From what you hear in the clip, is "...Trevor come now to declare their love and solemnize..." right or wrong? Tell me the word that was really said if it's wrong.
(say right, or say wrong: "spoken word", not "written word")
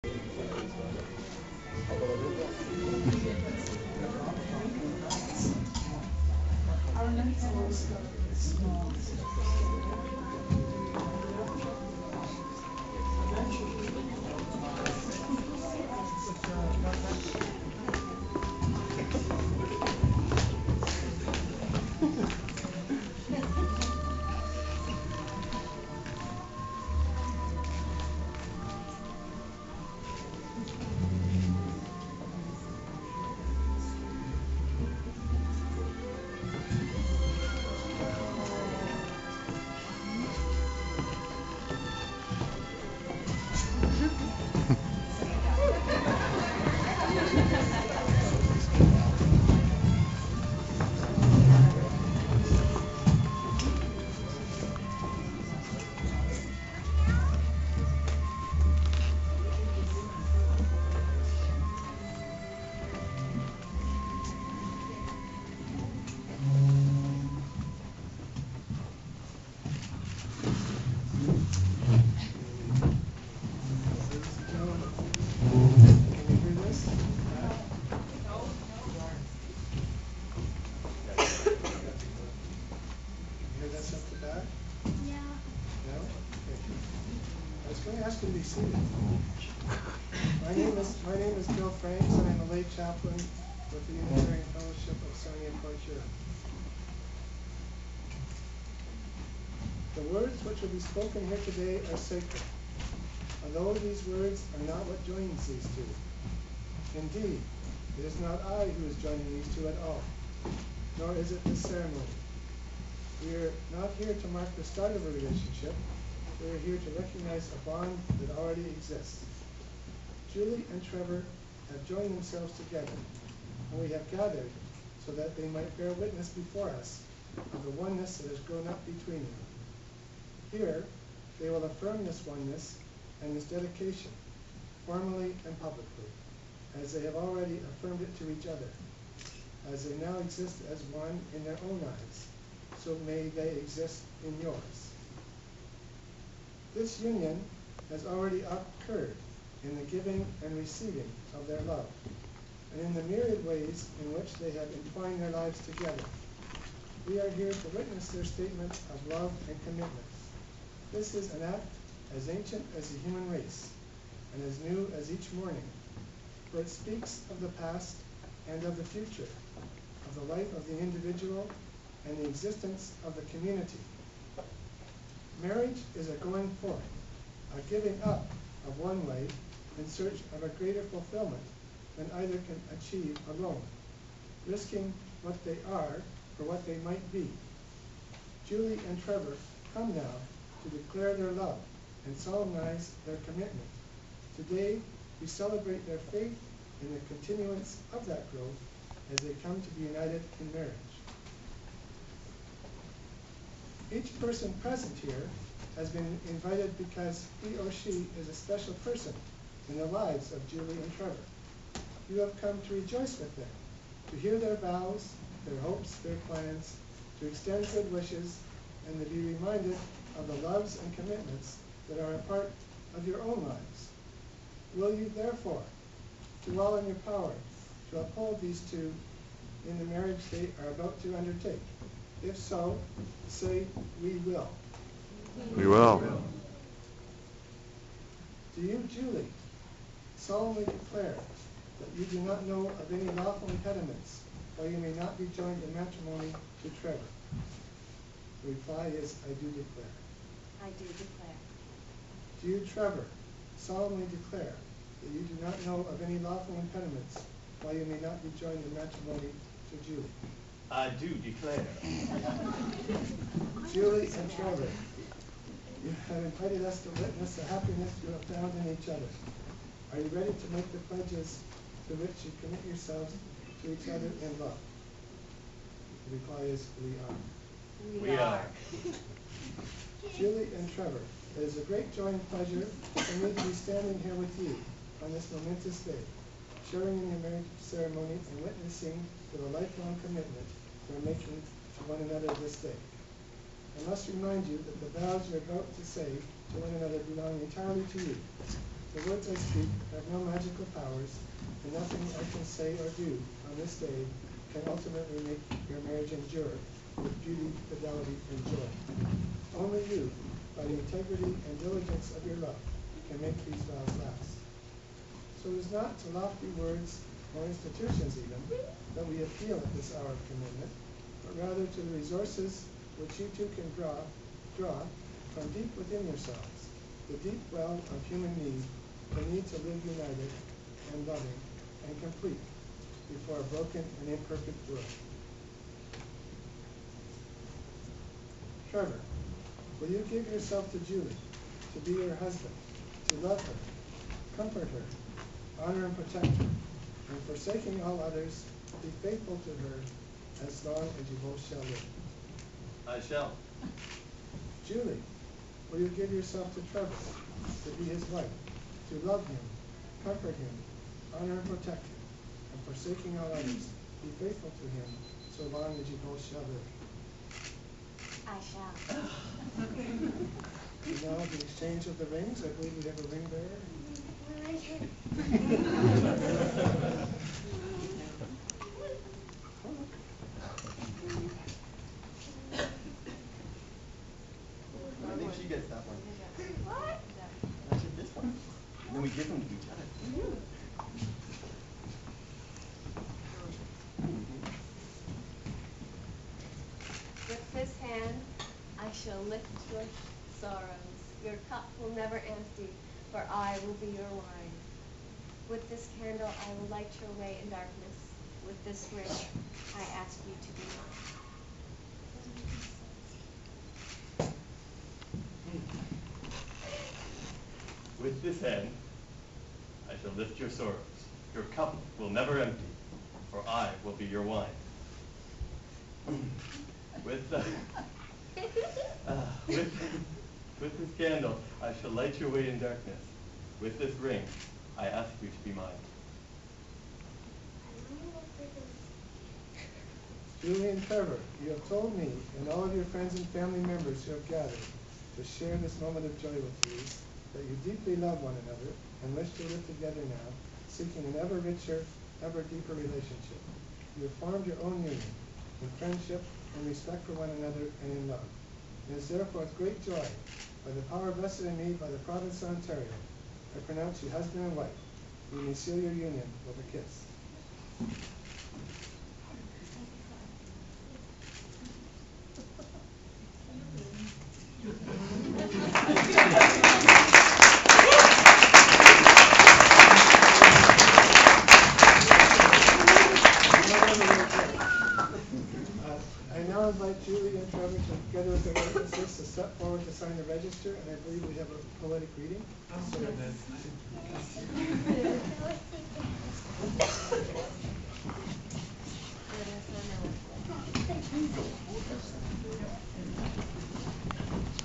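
right.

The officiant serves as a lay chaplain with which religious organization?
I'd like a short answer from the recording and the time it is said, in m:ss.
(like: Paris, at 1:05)
Unitarian Fellowship of Sarnia Point, at 1:33.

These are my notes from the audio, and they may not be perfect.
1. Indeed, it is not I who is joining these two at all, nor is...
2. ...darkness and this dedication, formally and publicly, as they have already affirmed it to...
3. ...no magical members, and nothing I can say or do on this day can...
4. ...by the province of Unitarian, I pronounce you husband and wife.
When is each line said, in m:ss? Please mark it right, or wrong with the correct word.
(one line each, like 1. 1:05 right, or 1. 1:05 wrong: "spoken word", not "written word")
1. 1:46 right
2. 2:12 wrong: "oneness", not "darkness"
3. 5:00 wrong: "powers", not "members"
4. 7:41 wrong: "Ontario", not "Unitarian".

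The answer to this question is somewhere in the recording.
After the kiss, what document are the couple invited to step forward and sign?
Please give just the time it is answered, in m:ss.
8:10.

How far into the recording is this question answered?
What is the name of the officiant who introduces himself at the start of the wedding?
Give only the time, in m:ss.
1:31.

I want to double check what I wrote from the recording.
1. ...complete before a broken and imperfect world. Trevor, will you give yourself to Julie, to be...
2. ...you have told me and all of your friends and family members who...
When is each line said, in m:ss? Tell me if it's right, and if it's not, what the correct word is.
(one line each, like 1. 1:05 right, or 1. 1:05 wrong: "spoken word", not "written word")
1. 5:32 right
2. 7:21 right.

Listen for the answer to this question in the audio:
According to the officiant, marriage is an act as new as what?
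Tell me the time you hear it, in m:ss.
2:45.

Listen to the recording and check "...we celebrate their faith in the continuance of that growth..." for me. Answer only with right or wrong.
right.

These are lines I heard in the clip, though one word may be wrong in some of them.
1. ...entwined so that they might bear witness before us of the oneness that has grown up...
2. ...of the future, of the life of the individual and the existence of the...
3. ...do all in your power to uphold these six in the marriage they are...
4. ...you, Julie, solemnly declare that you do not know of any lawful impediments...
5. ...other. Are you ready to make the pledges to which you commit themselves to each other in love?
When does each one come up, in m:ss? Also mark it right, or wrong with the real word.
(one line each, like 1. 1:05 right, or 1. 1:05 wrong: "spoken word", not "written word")
1. 2:04 wrong: "gathered", not "entwined"
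2. 2:48 right
3. 3:46 wrong: "two", not "six"
4. 3:58 right
5. 4:28 wrong: "yourselves", not "themselves".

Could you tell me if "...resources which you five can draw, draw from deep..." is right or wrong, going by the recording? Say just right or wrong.
wrong.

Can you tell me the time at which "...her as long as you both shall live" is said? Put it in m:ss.
5:49.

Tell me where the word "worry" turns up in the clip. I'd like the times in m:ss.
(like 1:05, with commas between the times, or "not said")
not said.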